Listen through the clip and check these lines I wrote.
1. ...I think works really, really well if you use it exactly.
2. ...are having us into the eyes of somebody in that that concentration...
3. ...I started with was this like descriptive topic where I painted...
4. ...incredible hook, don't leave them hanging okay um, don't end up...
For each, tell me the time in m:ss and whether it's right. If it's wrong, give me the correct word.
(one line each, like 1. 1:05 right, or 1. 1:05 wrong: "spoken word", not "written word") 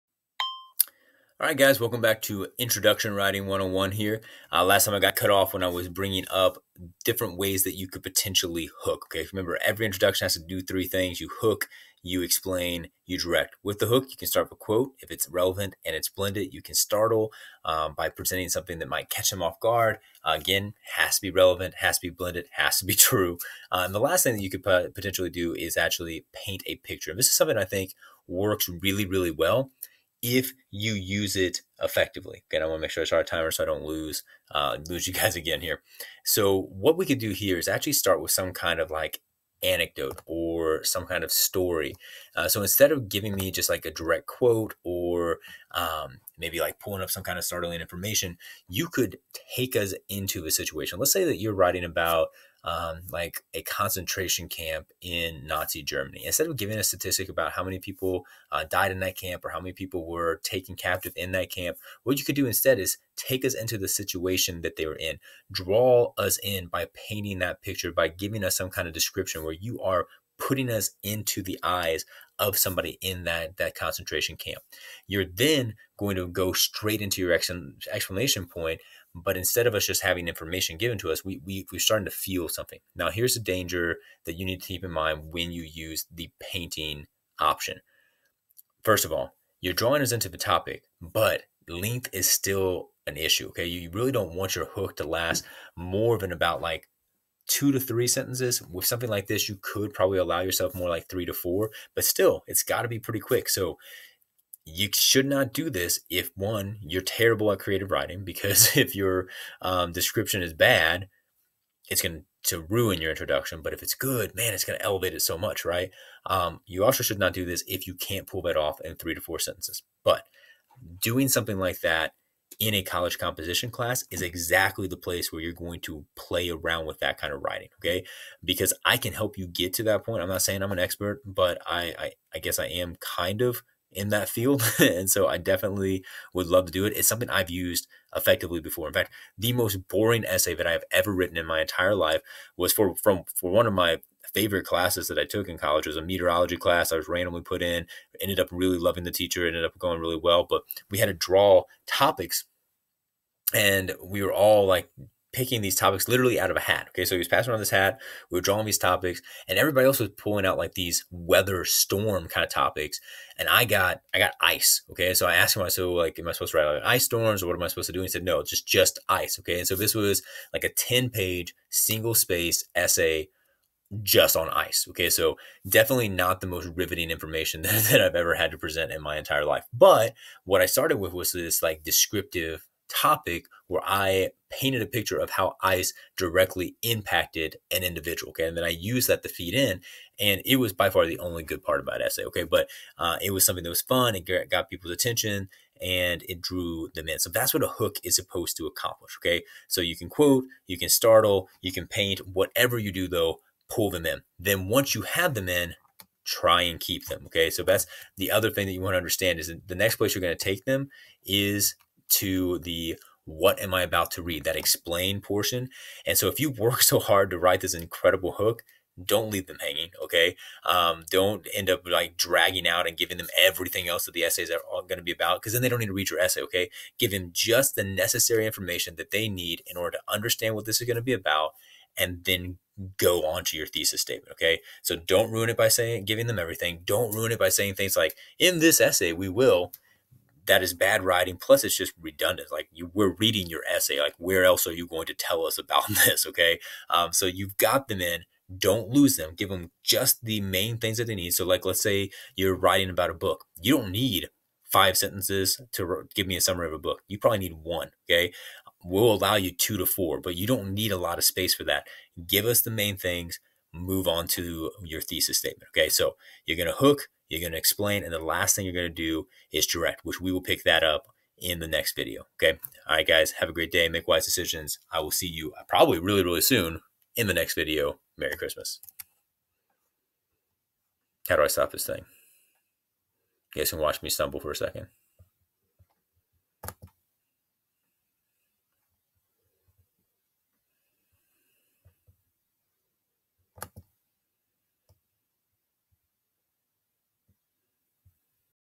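1. 0:27 wrong: "effectively", not "exactly"
2. 1:09 wrong: "putting", not "having"
3. 3:00 right
4. 3:37 right.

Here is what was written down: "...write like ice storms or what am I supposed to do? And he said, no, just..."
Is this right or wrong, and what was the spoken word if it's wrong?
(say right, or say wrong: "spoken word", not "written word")
right.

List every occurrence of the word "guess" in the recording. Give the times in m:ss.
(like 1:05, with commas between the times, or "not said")
2:12.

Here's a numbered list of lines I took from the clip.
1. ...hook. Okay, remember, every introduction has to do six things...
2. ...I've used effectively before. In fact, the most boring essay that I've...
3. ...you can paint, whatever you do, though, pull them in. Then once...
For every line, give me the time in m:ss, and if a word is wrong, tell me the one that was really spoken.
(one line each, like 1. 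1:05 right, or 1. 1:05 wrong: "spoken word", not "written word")
1. 0:08 wrong: "three", not "six"
2. 2:17 right
3. 3:21 right.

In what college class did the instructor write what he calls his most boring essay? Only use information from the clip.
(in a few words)
meteorology.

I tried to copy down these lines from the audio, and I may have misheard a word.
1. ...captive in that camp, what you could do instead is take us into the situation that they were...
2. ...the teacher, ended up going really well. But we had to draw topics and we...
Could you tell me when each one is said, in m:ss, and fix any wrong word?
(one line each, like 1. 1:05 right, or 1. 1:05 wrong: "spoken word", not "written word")
1. 1:00 right
2. 2:29 right.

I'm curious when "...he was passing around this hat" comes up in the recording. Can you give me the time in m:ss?
2:37.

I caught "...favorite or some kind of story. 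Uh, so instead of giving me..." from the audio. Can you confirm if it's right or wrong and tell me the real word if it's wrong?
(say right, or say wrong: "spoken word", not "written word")
wrong: "anecdote", not "favorite".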